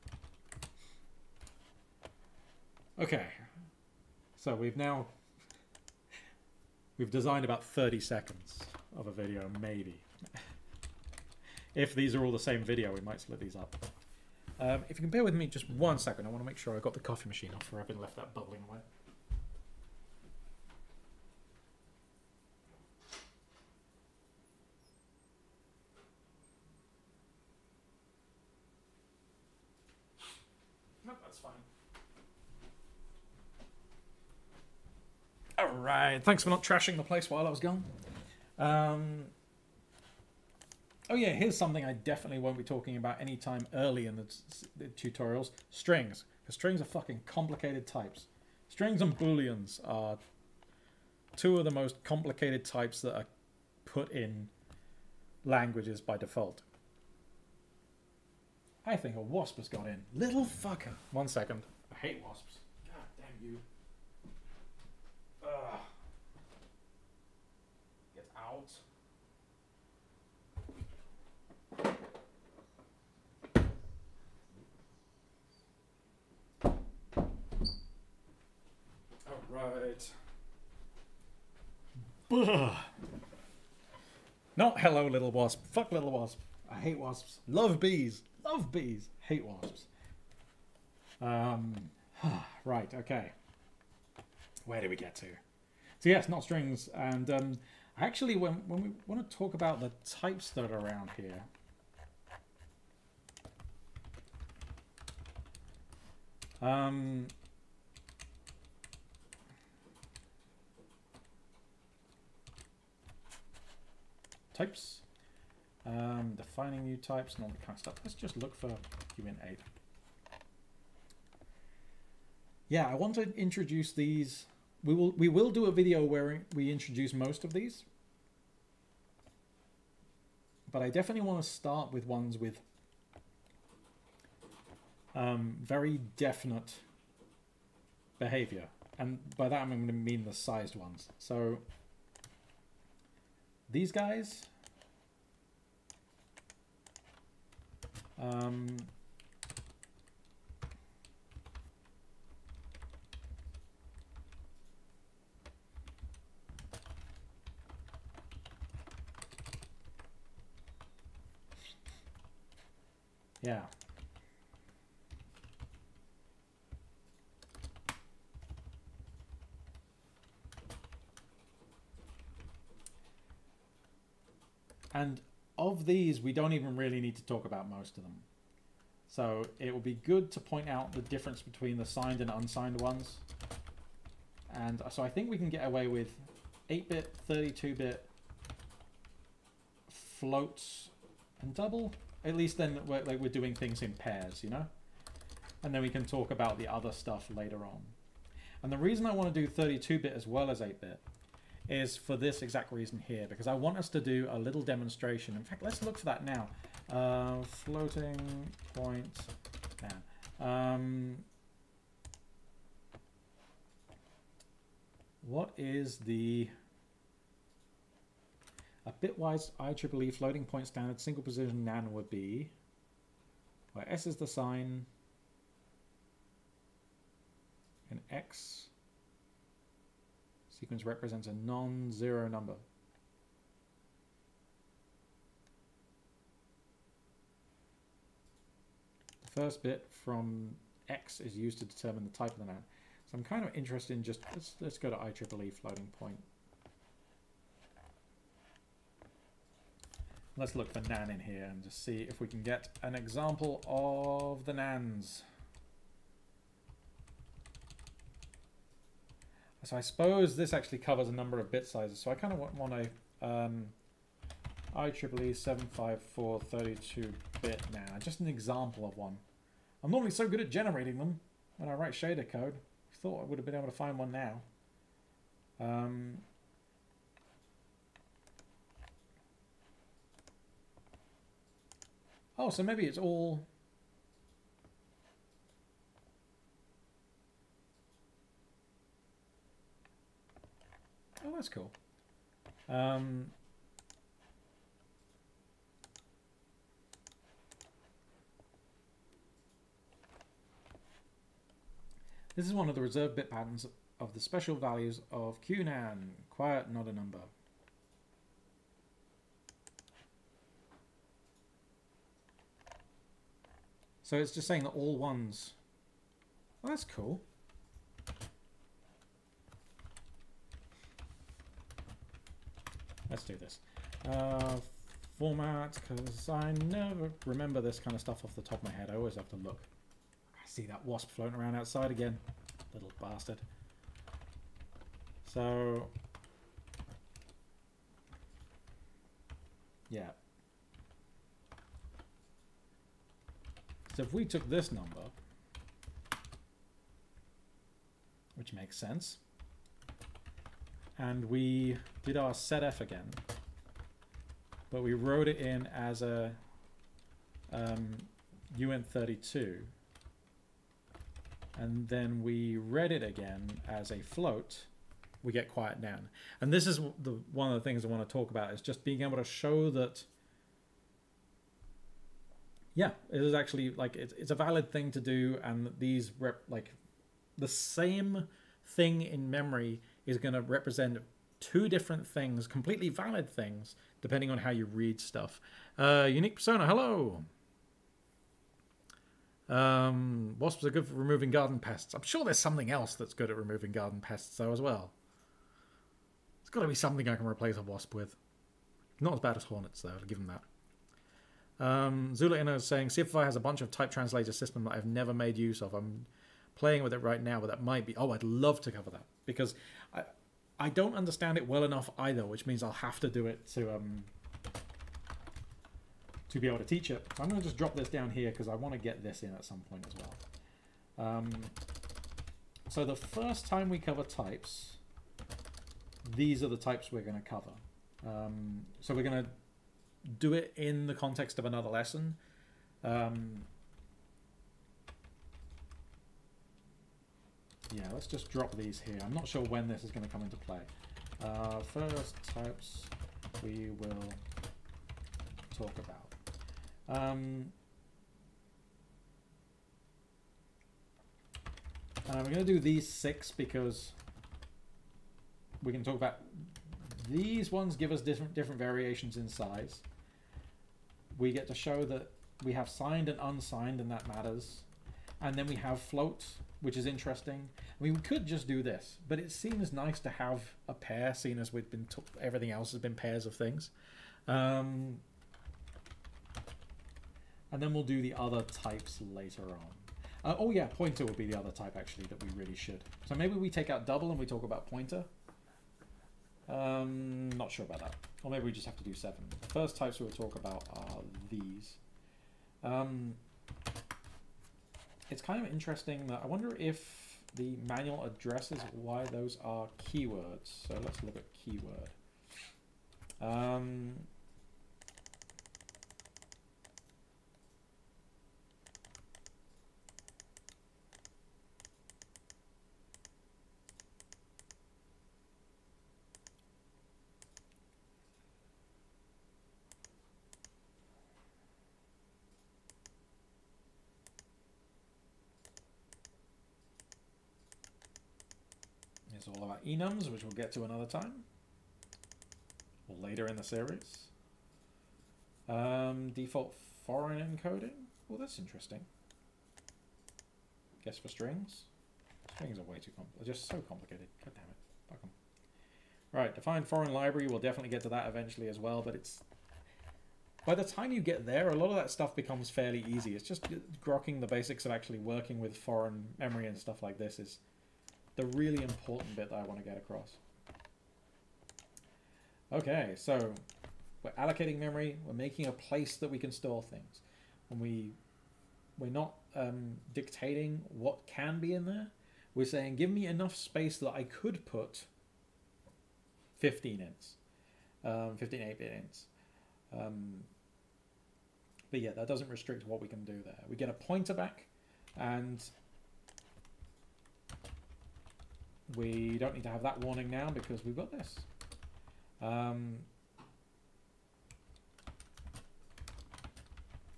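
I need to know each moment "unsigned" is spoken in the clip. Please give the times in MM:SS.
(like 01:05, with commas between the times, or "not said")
03:02, 07:43.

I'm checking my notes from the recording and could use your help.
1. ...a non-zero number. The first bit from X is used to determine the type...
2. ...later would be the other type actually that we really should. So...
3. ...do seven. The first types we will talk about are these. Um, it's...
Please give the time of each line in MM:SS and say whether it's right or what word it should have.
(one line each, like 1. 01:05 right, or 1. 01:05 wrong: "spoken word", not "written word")
1. 03:51 right
2. 08:00 wrong: "pointer", not "later"
3. 08:08 right.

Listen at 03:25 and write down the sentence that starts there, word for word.
In fact, let's look for that now.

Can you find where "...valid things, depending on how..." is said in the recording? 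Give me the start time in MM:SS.
06:22.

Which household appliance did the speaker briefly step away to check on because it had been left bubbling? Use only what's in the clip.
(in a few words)
coffee machine.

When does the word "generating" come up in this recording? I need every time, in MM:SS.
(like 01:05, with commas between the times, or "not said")
04:30.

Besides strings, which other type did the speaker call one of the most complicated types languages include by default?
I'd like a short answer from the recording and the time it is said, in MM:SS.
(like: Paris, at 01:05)
booleans, at 00:49.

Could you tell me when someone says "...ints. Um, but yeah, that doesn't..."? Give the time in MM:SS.
09:38.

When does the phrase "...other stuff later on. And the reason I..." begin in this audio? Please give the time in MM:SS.
03:16.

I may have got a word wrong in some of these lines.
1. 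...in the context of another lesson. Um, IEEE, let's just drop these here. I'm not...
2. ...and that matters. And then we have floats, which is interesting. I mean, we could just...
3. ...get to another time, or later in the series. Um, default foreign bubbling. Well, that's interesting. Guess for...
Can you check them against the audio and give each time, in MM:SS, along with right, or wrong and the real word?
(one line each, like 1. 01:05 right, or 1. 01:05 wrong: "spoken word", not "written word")
1. 07:10 wrong: "Yeah", not "IEEE"
2. 07:43 right
3. 08:50 wrong: "encoding", not "bubbling".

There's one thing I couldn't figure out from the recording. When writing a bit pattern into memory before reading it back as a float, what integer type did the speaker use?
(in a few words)
uint32.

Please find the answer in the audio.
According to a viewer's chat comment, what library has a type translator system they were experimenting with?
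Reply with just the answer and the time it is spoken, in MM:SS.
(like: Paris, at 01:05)
CFFI, at 06:42.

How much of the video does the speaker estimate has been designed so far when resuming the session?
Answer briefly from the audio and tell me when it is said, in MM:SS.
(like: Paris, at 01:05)
30 seconds, at 00:07.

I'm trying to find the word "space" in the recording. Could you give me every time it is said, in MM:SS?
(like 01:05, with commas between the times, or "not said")
09:33.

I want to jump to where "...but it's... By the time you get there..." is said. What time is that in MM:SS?
09:08.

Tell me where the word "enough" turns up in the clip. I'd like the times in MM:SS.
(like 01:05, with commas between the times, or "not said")
06:51, 09:33.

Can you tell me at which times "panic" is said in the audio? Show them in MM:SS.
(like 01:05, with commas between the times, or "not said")
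not said.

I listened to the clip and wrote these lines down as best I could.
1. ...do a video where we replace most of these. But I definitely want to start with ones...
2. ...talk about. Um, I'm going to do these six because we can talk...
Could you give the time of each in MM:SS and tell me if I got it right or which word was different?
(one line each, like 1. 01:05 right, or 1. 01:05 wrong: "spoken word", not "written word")
1. 02:05 wrong: "introduce", not "replace"
2. 07:25 right.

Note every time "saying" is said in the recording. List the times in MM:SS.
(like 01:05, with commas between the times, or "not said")
05:14, 06:42, 09:32.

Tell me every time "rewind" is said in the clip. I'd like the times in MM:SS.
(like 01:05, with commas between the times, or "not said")
not said.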